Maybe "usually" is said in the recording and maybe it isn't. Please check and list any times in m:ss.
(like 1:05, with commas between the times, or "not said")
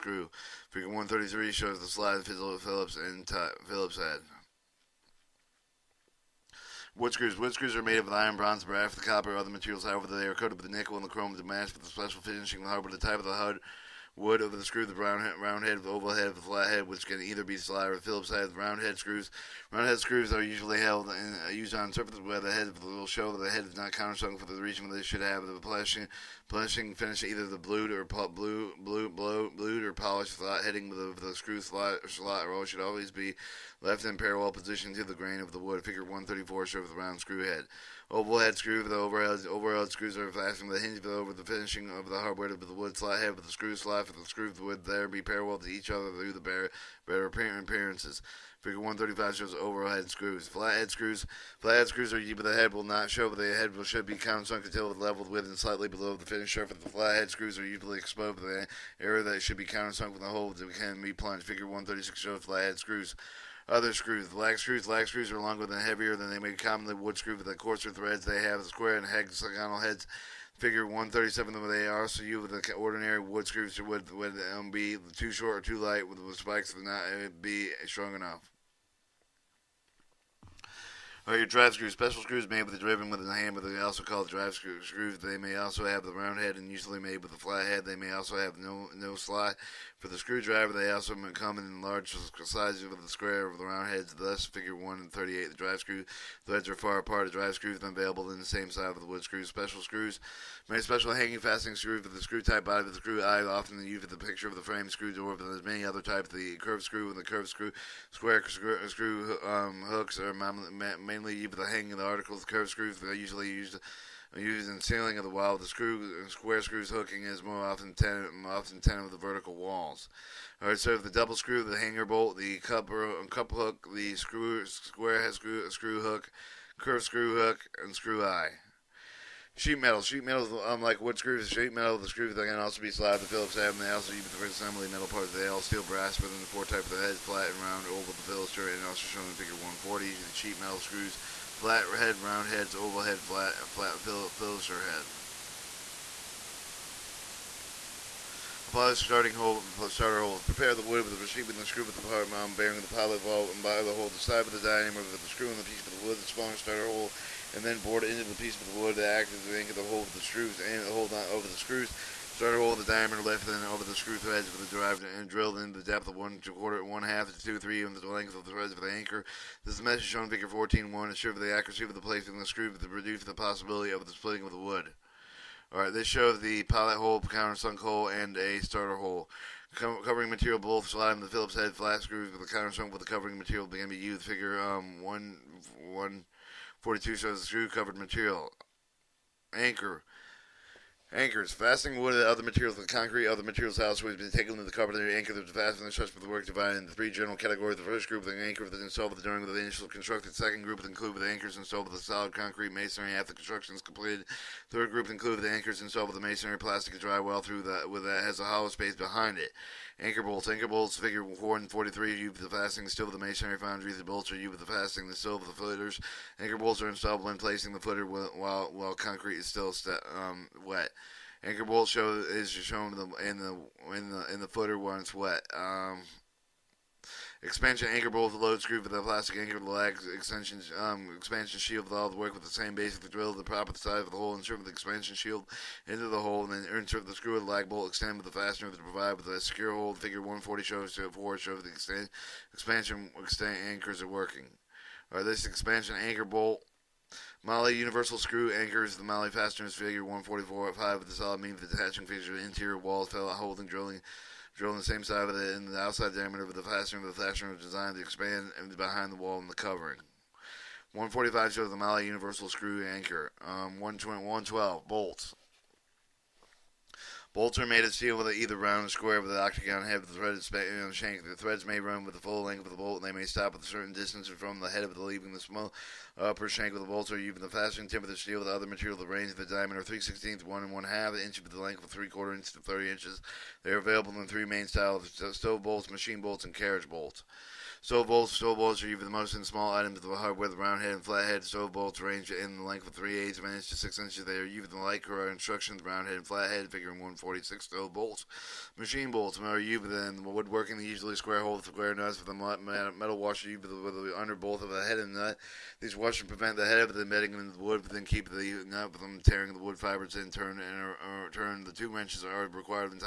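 0:20, 0:57, 1:26, 1:53, 5:00.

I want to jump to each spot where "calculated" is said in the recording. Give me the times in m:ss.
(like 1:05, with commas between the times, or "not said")
not said.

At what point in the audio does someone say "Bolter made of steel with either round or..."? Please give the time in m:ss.
4:27.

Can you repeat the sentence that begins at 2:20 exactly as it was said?
The sheet metal screws, flat head, round heads, oval head, flat, and flat phil- head.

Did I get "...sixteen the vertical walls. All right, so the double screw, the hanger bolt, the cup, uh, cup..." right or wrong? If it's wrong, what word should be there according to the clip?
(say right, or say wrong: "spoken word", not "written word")
wrong: "ten", not "sixteen".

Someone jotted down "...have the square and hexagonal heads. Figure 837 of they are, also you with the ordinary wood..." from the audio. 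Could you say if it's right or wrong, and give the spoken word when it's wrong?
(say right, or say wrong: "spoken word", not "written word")
wrong: "137", not "837".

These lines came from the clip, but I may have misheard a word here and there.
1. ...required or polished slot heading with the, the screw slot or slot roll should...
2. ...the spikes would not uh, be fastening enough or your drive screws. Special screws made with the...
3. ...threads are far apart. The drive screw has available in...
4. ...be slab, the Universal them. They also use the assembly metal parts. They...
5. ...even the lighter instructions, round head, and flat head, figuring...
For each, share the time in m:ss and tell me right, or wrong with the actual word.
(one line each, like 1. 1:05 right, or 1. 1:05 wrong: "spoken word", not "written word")
1. 0:29 wrong: "blued", not "required"
2. 1:16 wrong: "strong", not "fastening"
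3. 1:36 right
4. 2:12 wrong: "Phillips", not "Universal"
5. 4:54 right.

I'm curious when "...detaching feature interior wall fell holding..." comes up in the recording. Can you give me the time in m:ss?
4:11.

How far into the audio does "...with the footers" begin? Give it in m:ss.
3:35.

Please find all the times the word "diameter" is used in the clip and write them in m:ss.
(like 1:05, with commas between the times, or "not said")
2:34, 2:42, 4:16, 4:39.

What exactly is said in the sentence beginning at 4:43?
They are available in three main styles stove bolts, machine bolts, and carriage bolts.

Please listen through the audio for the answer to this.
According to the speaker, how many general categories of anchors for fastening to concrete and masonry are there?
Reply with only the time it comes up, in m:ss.
3:16.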